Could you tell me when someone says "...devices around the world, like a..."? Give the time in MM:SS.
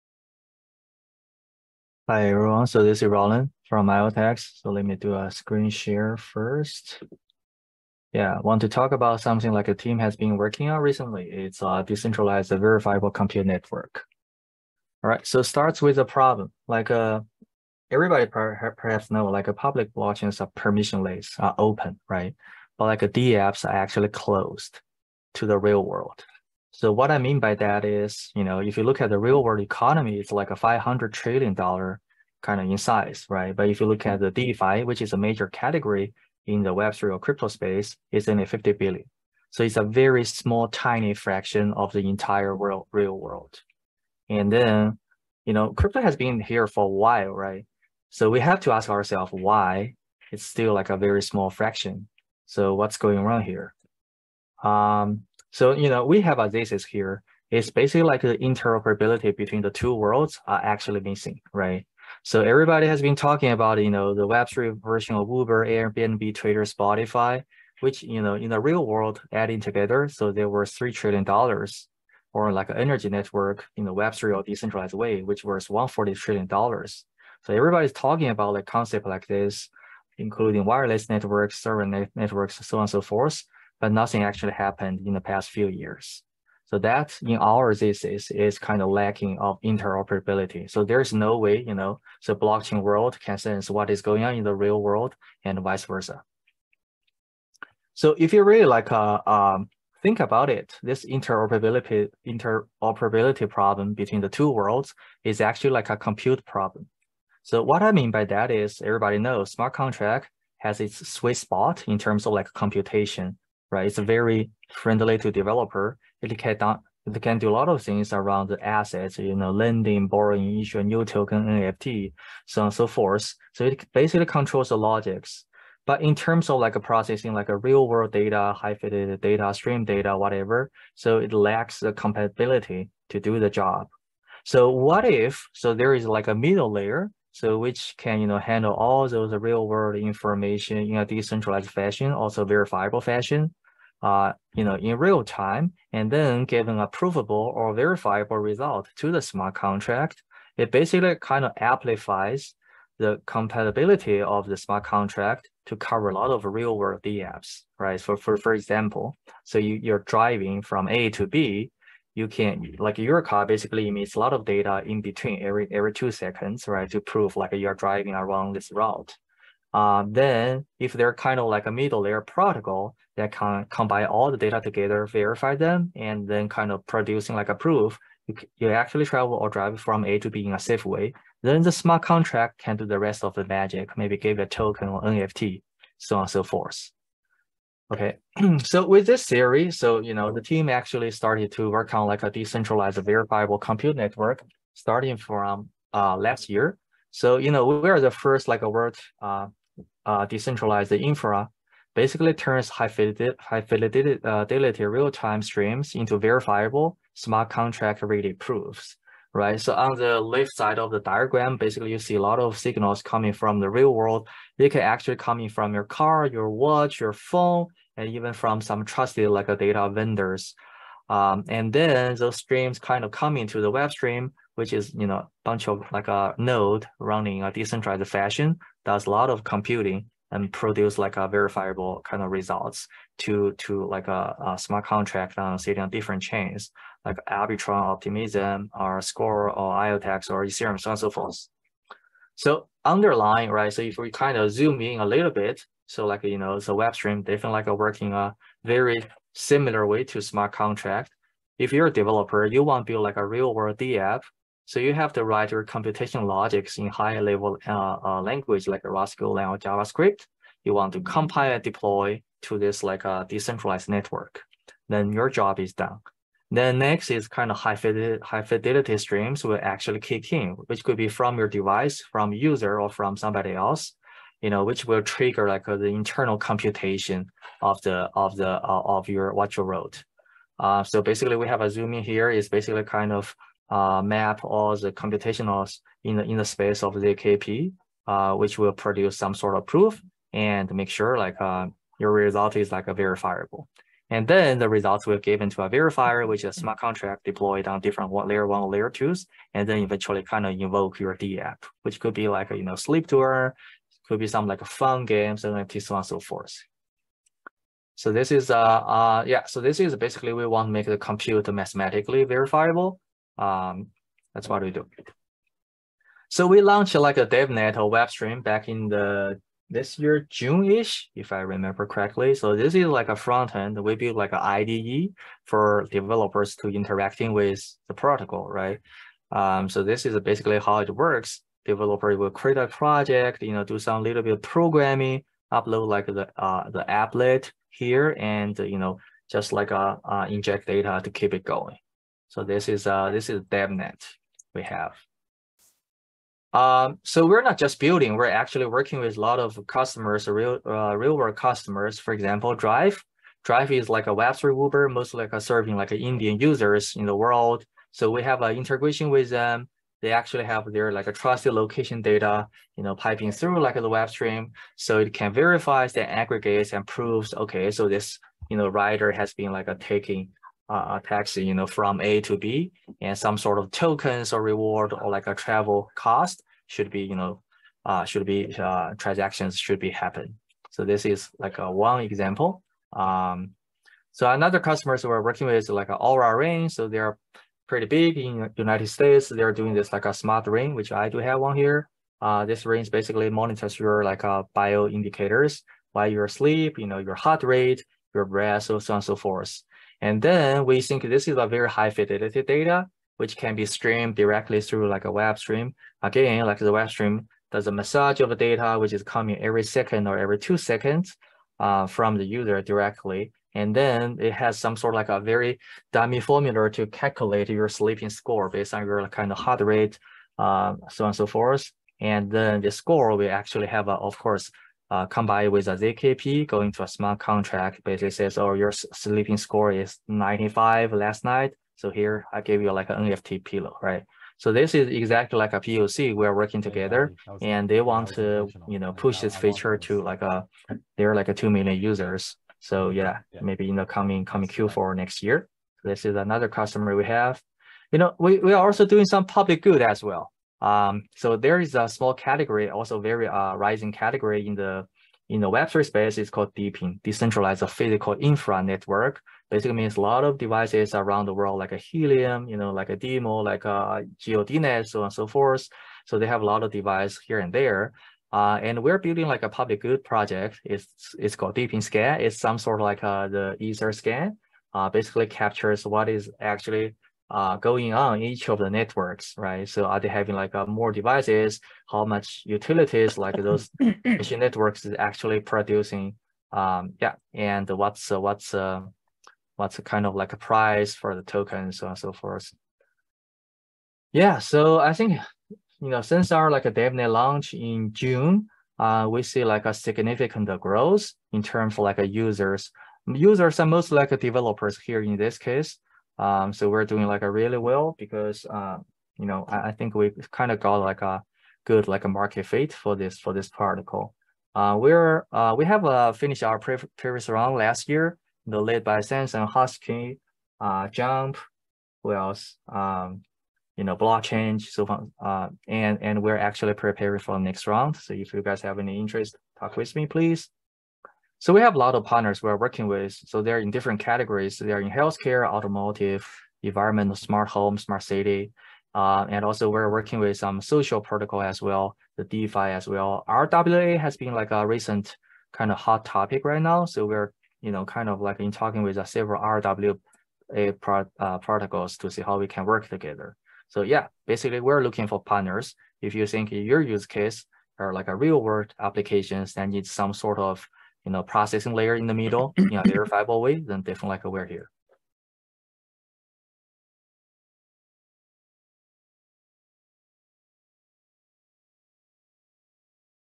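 07:40.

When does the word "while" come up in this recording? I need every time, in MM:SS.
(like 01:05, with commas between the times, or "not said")
00:46, 06:35.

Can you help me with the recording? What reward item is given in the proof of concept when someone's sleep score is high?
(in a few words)
NFT pillow.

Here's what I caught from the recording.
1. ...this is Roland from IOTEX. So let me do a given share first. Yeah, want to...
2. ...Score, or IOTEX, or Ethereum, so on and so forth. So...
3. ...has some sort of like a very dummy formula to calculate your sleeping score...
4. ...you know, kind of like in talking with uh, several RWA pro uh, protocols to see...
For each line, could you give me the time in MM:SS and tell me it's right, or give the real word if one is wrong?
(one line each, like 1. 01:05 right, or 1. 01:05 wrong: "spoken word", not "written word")
1. 00:02 wrong: "screen", not "given"
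2. 03:59 right
3. 06:54 right
4. 09:07 right.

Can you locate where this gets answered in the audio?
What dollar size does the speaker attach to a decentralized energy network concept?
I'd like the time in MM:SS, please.
01:15.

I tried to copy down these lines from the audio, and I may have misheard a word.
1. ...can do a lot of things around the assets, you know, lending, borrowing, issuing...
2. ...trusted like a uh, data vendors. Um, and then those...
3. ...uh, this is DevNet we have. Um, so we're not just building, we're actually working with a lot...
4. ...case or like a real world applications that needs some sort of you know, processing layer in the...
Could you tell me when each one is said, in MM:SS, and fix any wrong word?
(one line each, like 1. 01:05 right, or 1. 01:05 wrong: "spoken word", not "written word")
1. 01:57 right
2. 03:38 right
3. 05:42 right
4. 09:17 right.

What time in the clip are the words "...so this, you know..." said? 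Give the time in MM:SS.
06:07.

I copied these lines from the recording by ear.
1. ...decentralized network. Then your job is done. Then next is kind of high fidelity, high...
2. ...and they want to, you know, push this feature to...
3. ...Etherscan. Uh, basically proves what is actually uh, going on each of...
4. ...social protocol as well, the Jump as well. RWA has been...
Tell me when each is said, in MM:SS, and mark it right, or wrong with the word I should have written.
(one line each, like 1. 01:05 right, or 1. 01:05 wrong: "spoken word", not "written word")
1. 04:23 right
2. 07:17 right
3. 07:53 wrong: "captures", not "proves"
4. 09:00 wrong: "DeFi", not "Jump".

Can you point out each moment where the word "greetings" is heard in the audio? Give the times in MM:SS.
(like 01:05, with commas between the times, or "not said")
not said.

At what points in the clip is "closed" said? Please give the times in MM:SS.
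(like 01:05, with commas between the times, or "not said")
00:24.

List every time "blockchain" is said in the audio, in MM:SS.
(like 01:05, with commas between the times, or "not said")
00:19, 01:32, 08:43.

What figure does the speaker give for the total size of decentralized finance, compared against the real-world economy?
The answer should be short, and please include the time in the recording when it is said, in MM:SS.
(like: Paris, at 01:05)
50 billion, at 00:38.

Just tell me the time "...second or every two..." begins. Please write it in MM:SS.
06:49.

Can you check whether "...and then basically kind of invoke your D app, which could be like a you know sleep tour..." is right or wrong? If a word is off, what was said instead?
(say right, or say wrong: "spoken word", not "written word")
wrong: "eventually", not "basically".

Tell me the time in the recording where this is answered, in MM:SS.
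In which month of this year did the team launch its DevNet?
05:20.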